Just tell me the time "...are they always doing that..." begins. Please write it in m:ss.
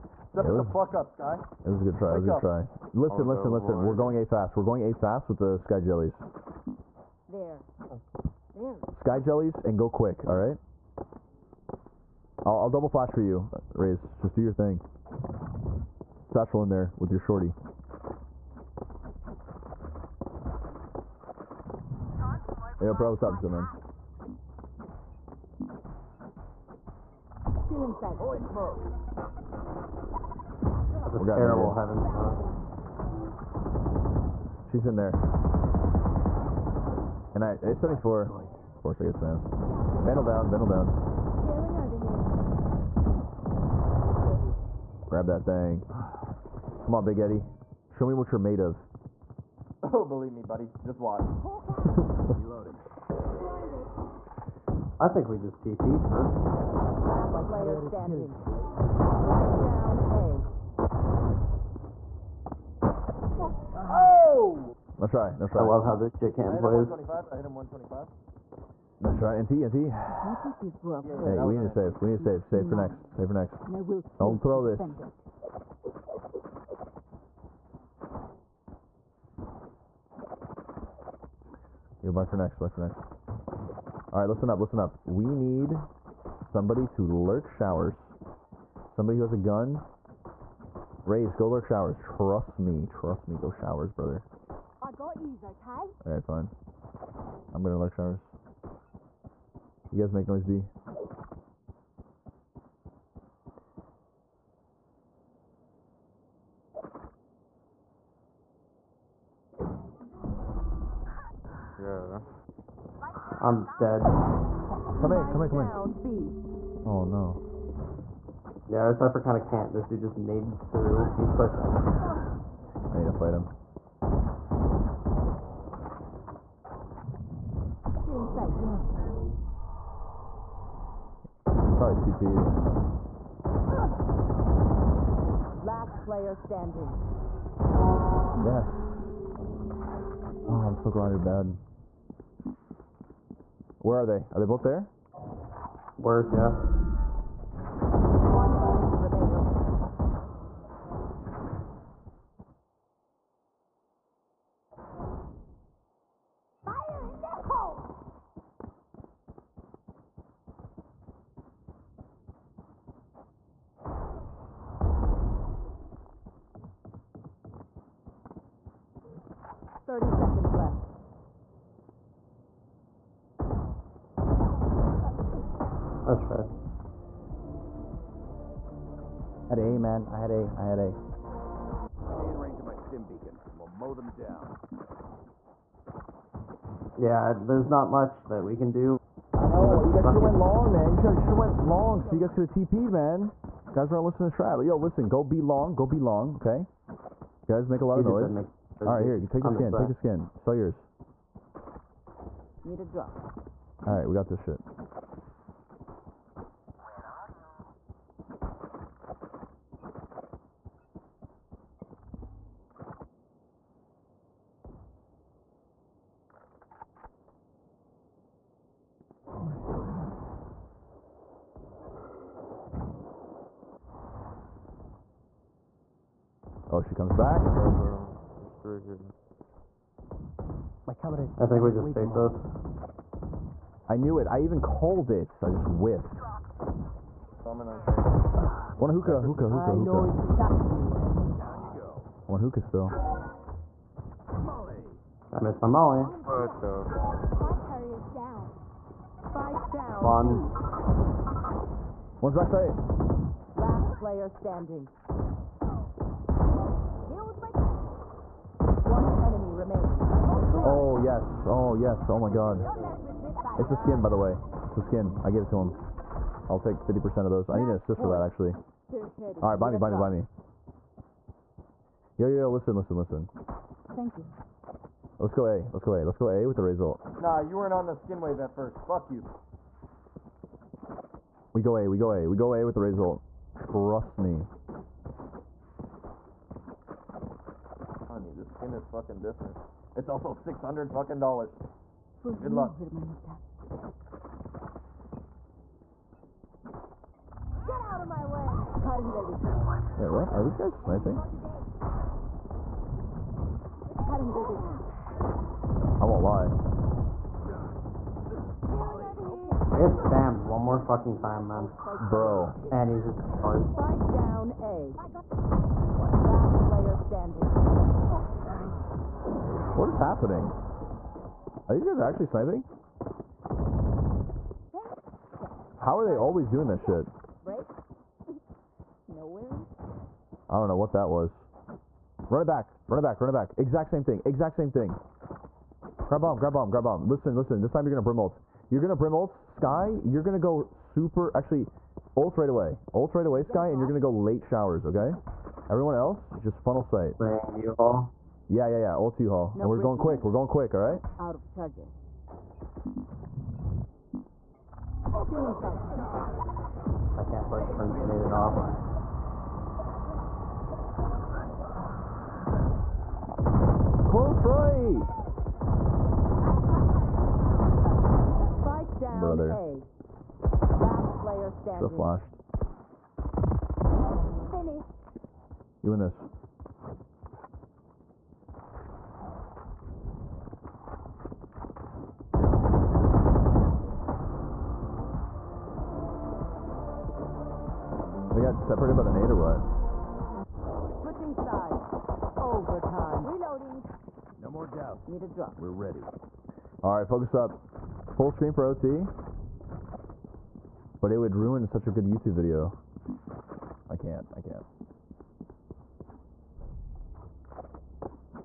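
5:25.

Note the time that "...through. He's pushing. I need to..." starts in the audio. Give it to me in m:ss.
2:00.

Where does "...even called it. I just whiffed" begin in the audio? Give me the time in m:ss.
3:54.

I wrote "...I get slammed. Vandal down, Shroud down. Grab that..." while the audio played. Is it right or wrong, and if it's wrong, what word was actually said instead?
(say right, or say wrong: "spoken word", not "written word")
wrong: "Vandal", not "Shroud".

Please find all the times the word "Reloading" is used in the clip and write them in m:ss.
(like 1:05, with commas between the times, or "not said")
0:52, 6:33.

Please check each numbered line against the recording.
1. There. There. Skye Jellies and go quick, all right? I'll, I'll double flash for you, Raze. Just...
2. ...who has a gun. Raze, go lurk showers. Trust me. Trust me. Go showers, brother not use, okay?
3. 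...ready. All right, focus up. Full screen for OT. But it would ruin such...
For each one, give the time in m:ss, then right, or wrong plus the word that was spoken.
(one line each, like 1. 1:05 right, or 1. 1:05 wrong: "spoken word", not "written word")
1. 0:07 right
2. 1:29 right
3. 6:35 right.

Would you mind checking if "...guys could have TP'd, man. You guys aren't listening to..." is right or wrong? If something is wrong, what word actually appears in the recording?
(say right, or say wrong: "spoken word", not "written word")
right.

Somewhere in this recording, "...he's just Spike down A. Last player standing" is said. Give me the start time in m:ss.
5:12.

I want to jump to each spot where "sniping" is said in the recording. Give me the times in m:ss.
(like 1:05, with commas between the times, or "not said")
5:00, 5:22.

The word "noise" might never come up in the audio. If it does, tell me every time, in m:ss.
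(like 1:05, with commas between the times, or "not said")
1:40, 3:18.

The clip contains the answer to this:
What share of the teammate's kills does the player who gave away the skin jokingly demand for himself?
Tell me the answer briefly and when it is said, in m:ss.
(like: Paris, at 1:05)
50%, at 4:26.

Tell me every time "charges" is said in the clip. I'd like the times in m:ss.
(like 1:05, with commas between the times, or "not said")
5:51.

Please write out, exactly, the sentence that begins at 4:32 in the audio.
Yo, yo, yo, listen, listen, listen.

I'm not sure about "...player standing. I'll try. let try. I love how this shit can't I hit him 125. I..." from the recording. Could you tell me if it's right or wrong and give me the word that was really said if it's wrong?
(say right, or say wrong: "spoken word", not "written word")
right.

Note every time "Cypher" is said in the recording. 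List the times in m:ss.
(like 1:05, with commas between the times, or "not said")
1:58.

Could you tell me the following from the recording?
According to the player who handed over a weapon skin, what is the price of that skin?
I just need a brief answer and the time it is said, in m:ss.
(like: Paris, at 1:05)
600 dollars, at 4:50.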